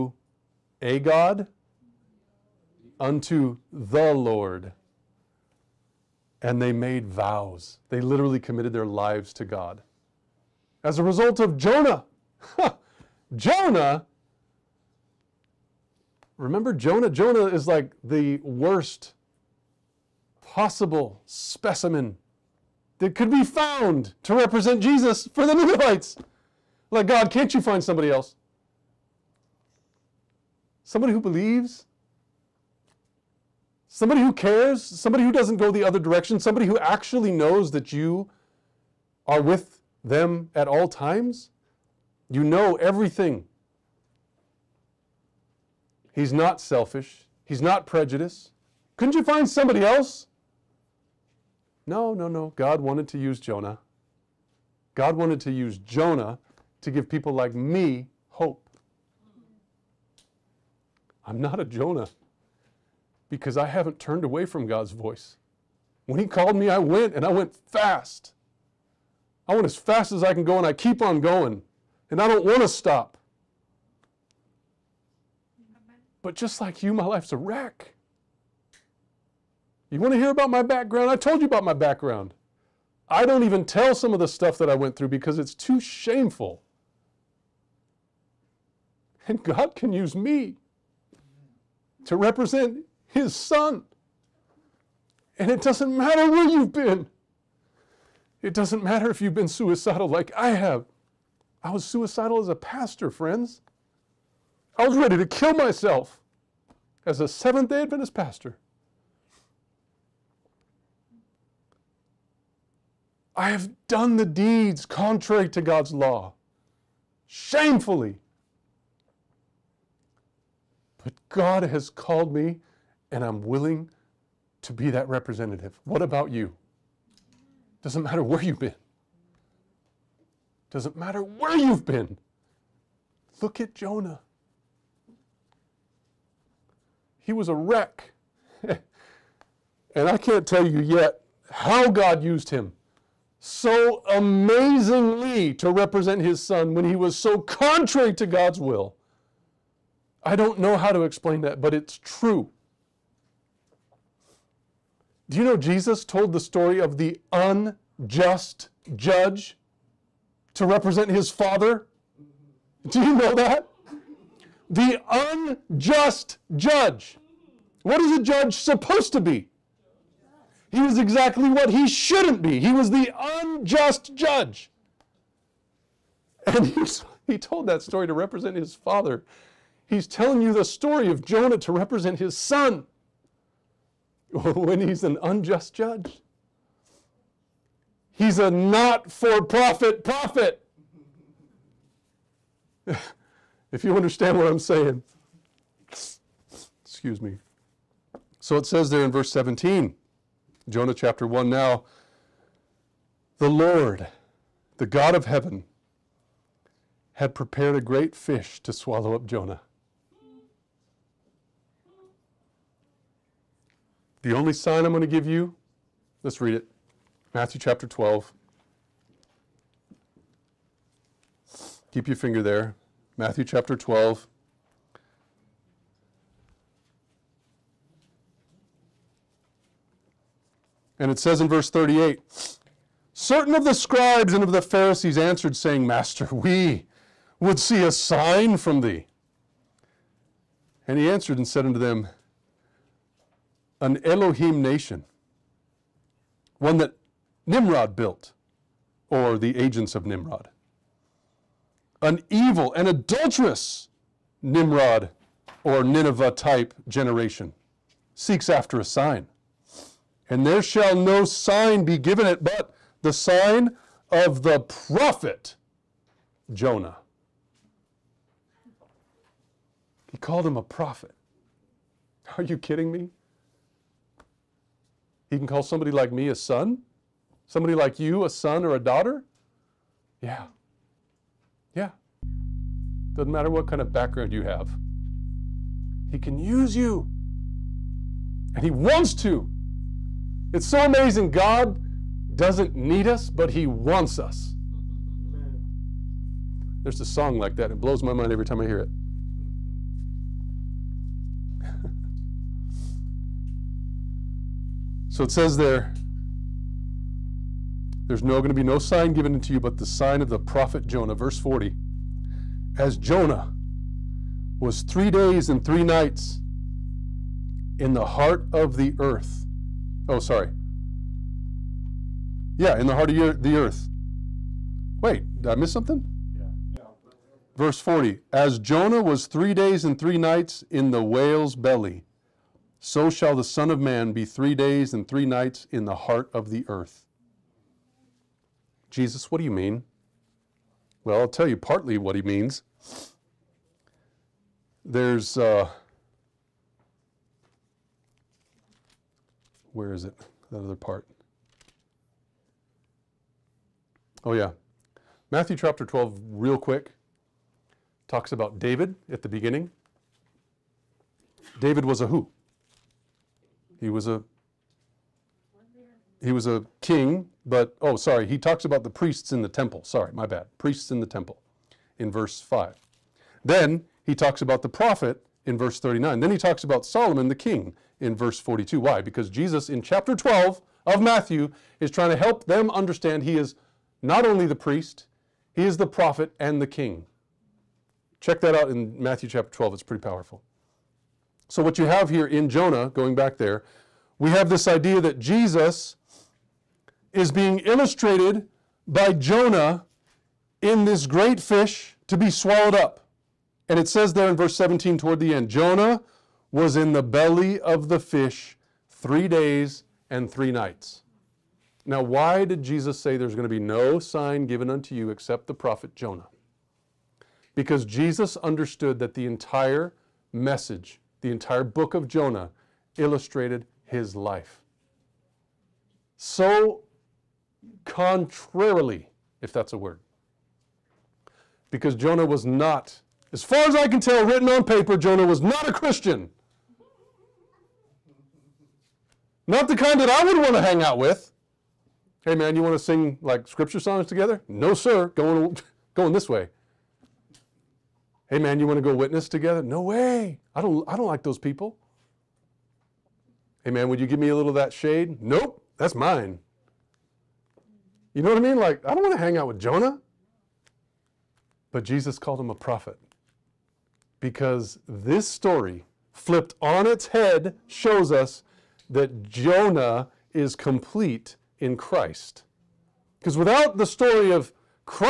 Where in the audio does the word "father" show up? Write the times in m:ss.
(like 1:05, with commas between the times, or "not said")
2:41, 2:58.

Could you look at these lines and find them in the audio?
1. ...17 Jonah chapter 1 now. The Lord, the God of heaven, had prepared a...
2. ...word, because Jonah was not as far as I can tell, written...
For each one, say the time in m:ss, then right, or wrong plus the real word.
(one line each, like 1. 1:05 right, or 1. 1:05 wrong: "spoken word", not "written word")
1. 3:19 right
2. 7:09 right.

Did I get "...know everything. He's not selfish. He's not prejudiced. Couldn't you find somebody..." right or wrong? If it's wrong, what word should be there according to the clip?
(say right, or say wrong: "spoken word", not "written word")
right.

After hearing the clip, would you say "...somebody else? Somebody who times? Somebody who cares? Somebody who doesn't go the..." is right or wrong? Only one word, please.
wrong.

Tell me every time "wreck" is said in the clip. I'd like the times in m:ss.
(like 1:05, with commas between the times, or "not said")
1:17, 2:17.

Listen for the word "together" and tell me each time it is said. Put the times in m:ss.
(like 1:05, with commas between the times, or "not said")
7:24, 7:29.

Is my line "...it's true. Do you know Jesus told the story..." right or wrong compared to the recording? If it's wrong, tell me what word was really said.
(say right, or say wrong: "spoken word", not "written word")
right.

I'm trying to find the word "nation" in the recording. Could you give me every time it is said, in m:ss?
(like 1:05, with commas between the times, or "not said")
4:04.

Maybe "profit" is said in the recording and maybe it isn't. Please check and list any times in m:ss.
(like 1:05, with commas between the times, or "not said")
3:09.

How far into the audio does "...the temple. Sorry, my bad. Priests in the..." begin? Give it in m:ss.
6:09.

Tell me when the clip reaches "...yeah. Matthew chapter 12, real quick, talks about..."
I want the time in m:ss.
5:54.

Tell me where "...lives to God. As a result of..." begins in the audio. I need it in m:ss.
0:08.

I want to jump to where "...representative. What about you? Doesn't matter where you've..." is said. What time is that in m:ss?
2:05.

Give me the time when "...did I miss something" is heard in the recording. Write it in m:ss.
5:25.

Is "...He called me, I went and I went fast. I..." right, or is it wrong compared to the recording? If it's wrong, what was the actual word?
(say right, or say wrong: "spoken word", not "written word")
right.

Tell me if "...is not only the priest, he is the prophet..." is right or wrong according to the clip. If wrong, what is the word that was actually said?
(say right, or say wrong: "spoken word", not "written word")
right.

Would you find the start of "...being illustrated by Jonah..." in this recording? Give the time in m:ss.
6:37.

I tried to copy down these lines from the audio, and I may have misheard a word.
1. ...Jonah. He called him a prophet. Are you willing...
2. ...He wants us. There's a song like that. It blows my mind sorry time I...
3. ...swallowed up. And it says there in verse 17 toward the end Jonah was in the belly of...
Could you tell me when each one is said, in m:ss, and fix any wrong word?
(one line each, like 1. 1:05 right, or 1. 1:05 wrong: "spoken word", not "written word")
1. 4:26 wrong: "kidding", not "willing"
2. 4:53 wrong: "every", not "sorry"
3. 6:42 right.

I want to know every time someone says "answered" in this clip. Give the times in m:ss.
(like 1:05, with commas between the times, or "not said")
3:55, 4:01.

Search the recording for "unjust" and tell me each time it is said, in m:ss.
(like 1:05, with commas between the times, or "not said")
2:37, 2:45, 2:53, 3:05.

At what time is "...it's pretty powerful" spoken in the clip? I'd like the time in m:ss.
6:29.